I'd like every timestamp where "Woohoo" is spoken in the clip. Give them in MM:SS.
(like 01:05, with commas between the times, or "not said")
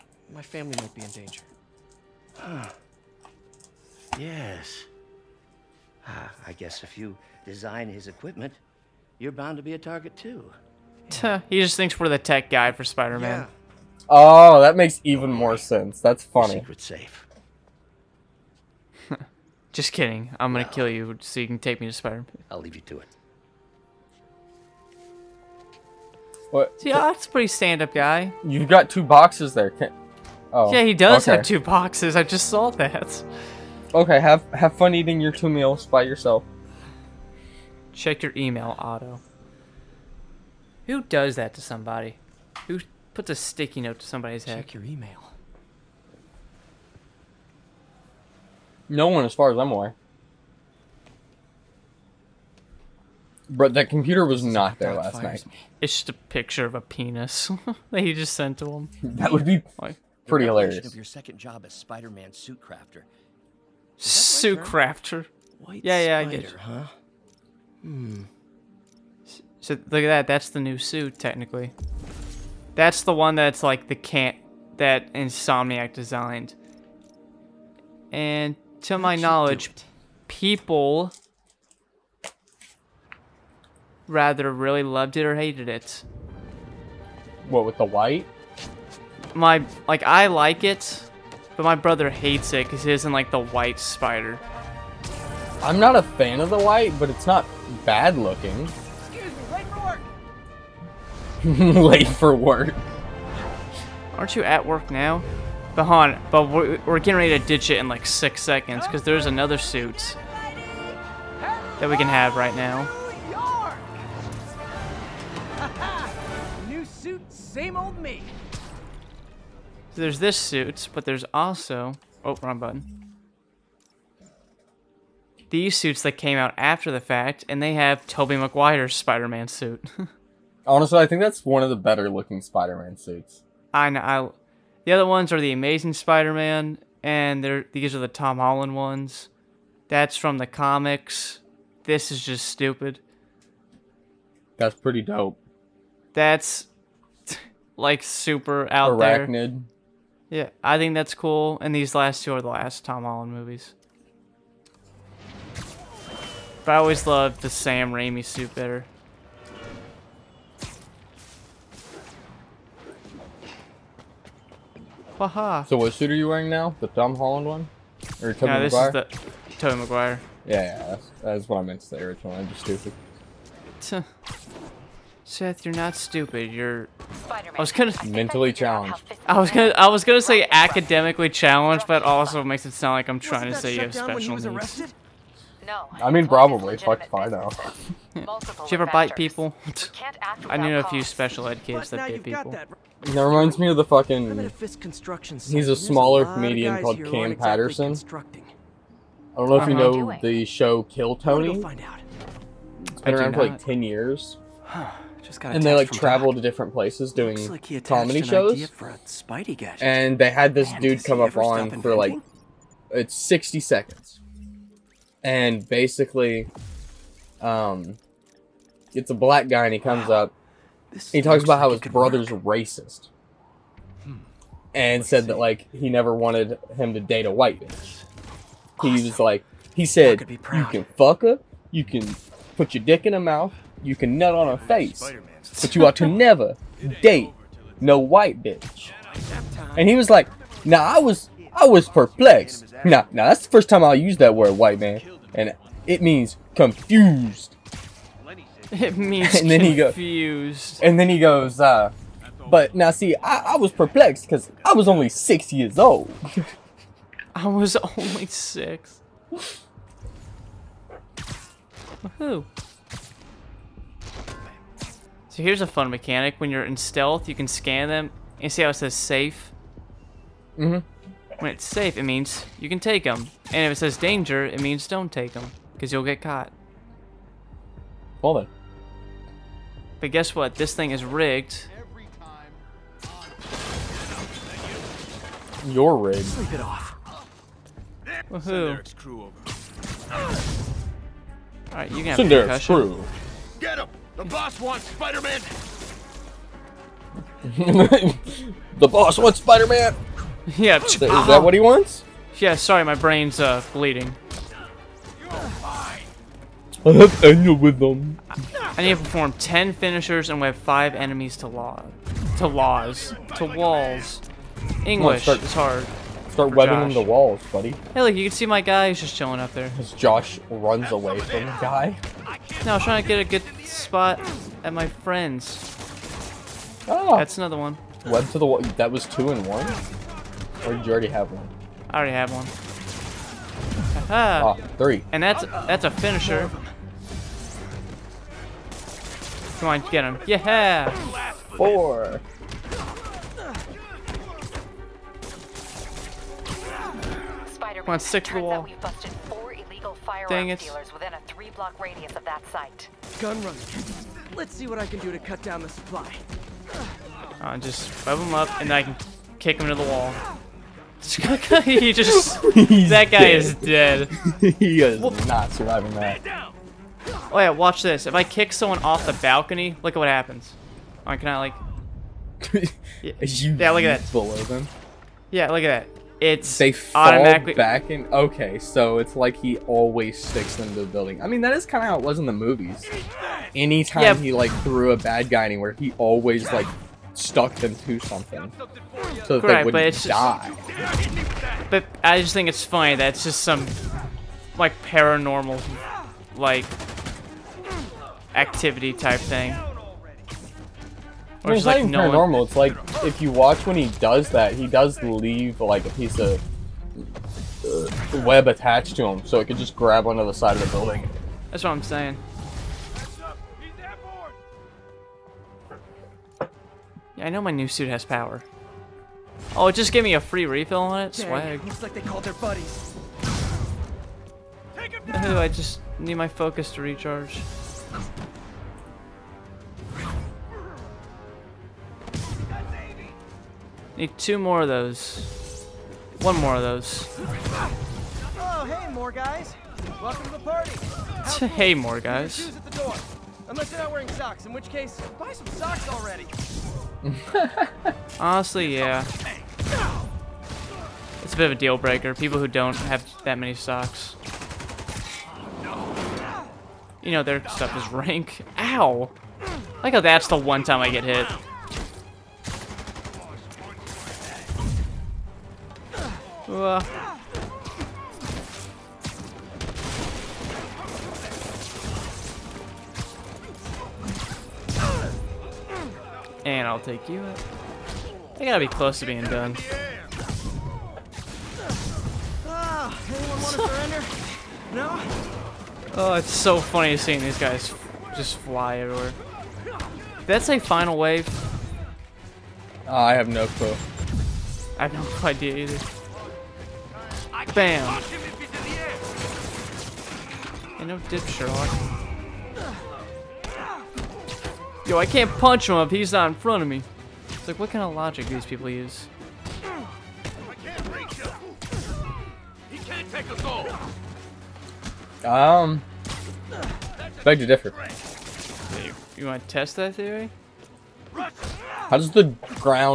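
04:48.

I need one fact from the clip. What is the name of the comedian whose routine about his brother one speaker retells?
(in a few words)
Cam Patterson.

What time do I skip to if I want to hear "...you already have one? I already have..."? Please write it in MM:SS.
05:30.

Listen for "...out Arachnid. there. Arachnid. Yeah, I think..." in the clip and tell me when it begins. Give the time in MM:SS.
02:28.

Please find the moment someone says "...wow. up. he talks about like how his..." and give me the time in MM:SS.
03:40.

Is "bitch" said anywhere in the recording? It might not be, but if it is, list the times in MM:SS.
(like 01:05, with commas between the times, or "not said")
03:47, 03:58.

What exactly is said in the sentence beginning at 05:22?
No, I was trying to get a good spot at my friends.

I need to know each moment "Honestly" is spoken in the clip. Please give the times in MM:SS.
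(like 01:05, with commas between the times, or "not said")
02:10, 07:28.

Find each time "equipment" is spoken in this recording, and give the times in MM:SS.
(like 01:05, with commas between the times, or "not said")
00:08.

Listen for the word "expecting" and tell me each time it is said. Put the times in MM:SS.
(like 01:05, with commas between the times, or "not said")
not said.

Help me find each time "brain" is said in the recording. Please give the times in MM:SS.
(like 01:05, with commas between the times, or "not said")
05:02.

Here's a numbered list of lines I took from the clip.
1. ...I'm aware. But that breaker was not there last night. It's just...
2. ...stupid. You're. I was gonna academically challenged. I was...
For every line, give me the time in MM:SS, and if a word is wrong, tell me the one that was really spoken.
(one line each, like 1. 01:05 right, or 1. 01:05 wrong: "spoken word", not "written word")
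1. 00:49 wrong: "computer", not "breaker"
2. 02:55 wrong: "mentally", not "academically".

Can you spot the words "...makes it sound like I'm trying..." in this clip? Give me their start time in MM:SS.
03:02.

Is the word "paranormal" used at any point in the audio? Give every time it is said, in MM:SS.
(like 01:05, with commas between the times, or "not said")
06:34, 06:42.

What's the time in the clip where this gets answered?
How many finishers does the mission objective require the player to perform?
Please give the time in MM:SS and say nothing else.
05:09.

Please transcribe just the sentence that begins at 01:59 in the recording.
So there's this suit, but there's also oh wrong button.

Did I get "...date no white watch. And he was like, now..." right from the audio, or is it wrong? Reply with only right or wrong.
wrong.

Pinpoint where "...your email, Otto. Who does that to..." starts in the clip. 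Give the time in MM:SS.
00:38.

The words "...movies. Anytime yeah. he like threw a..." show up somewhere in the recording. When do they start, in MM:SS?
06:22.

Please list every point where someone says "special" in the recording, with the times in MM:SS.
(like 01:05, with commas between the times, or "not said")
03:03, 03:11.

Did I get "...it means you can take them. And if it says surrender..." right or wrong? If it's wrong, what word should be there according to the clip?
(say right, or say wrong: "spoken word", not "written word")
wrong: "danger", not "surrender".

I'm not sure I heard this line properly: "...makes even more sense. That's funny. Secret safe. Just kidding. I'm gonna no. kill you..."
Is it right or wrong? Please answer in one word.
right.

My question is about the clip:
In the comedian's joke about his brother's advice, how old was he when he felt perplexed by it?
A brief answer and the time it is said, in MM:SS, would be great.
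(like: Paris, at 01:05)
6, at 04:15.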